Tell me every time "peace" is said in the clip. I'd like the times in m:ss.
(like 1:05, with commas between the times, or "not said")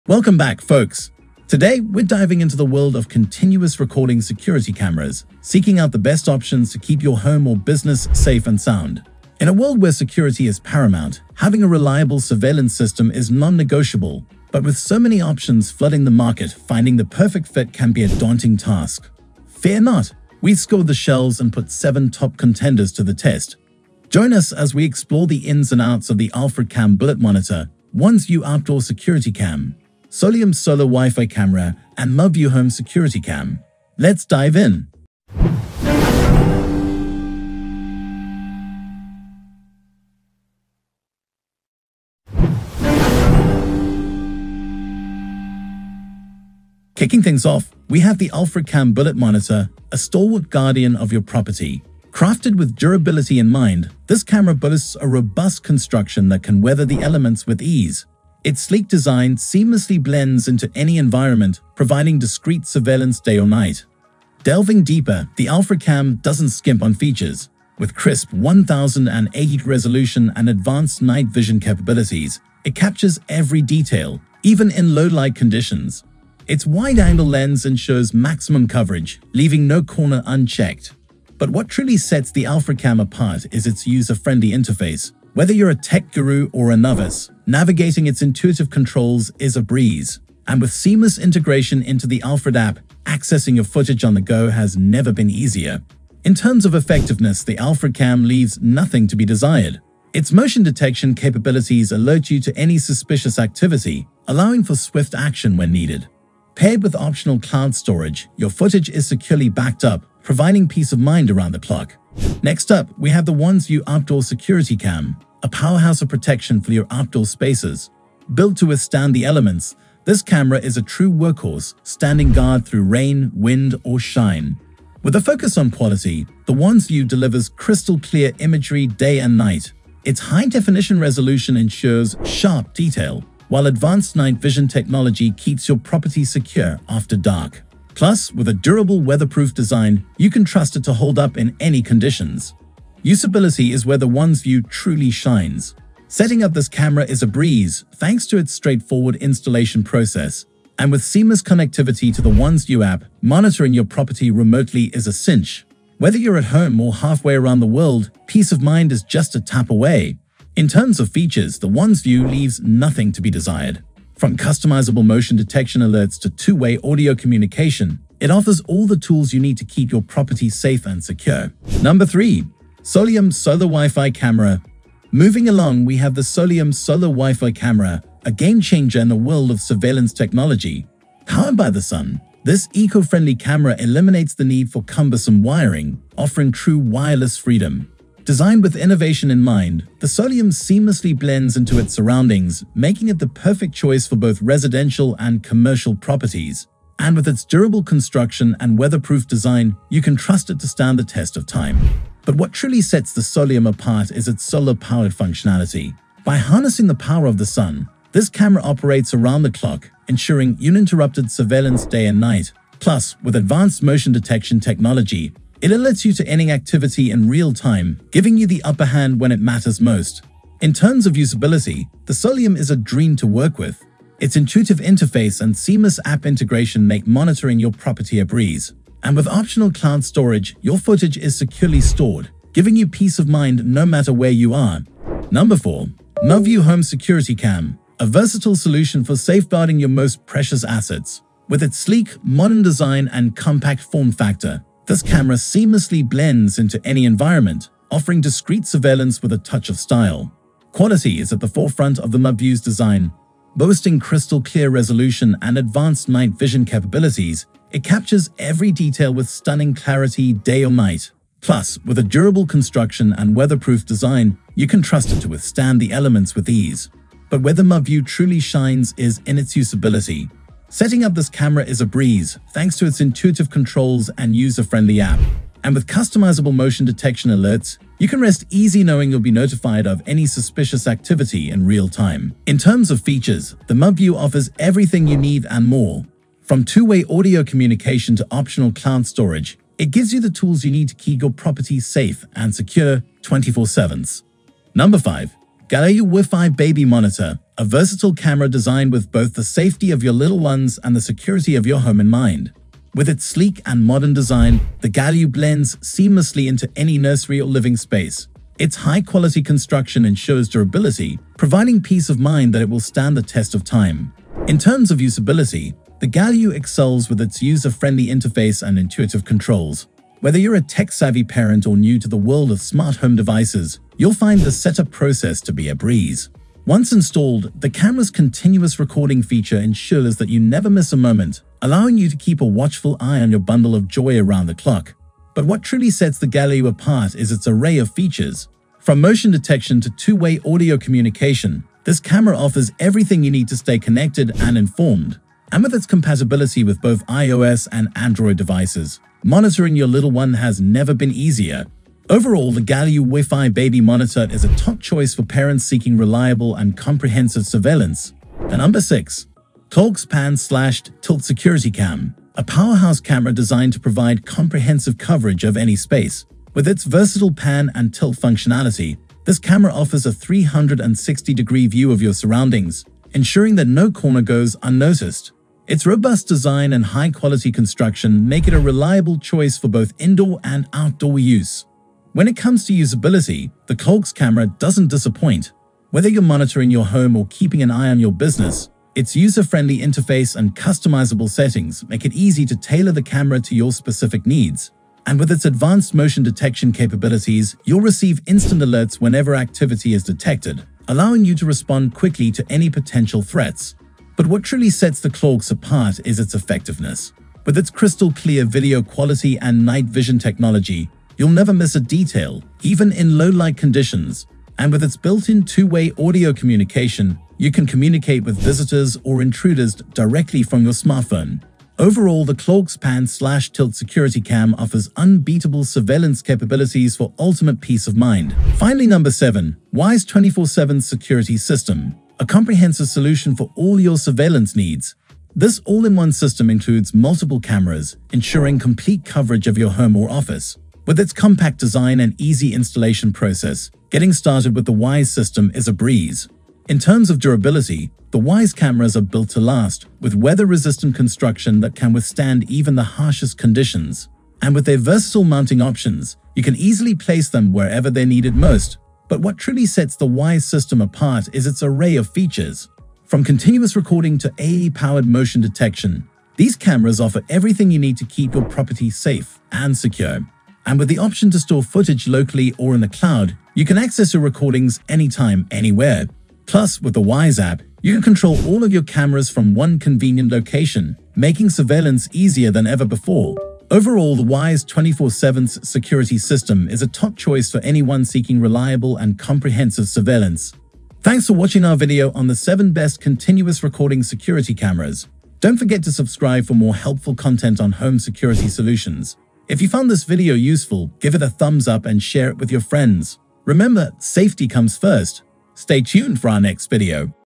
1:50, 2:38, 3:52, 5:11, 7:07.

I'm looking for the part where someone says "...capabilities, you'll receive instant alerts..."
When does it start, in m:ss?
6:36.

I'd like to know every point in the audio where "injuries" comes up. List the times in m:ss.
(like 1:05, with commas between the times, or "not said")
not said.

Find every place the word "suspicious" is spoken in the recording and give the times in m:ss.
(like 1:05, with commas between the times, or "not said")
1:42, 4:40.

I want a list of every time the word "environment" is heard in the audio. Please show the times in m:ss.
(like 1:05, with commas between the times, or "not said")
1:00, 4:07.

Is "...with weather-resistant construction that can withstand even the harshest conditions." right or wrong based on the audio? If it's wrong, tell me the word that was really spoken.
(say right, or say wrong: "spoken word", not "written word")
right.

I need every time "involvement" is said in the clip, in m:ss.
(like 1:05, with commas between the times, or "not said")
not said.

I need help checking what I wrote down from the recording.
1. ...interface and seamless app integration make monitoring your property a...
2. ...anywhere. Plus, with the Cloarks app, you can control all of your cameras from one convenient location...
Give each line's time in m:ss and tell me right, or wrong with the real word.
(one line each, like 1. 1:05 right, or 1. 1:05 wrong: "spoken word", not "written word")
1. 3:44 right
2. 7:55 wrong: "Wyze", not "Cloarks".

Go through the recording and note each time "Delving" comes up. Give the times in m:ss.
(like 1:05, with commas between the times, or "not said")
1:04.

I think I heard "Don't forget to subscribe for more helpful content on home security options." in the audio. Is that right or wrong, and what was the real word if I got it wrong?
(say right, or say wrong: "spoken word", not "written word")
wrong: "solutions", not "options".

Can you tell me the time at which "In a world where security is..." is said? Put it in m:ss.
0:09.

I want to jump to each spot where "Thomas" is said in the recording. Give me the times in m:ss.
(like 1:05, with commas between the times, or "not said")
not said.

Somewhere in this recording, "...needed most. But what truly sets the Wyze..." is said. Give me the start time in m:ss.
7:38.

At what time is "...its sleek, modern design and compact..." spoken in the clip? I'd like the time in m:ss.
4:01.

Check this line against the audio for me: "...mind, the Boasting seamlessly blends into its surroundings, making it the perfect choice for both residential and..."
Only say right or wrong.
wrong.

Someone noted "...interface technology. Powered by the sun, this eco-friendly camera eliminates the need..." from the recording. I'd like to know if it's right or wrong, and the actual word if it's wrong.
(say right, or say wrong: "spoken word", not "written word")
wrong: "surveillance", not "interface".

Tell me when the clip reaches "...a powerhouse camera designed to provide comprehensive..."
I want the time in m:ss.
6:02.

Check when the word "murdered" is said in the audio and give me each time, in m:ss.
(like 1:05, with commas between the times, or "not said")
not said.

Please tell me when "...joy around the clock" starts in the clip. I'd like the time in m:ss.
5:33.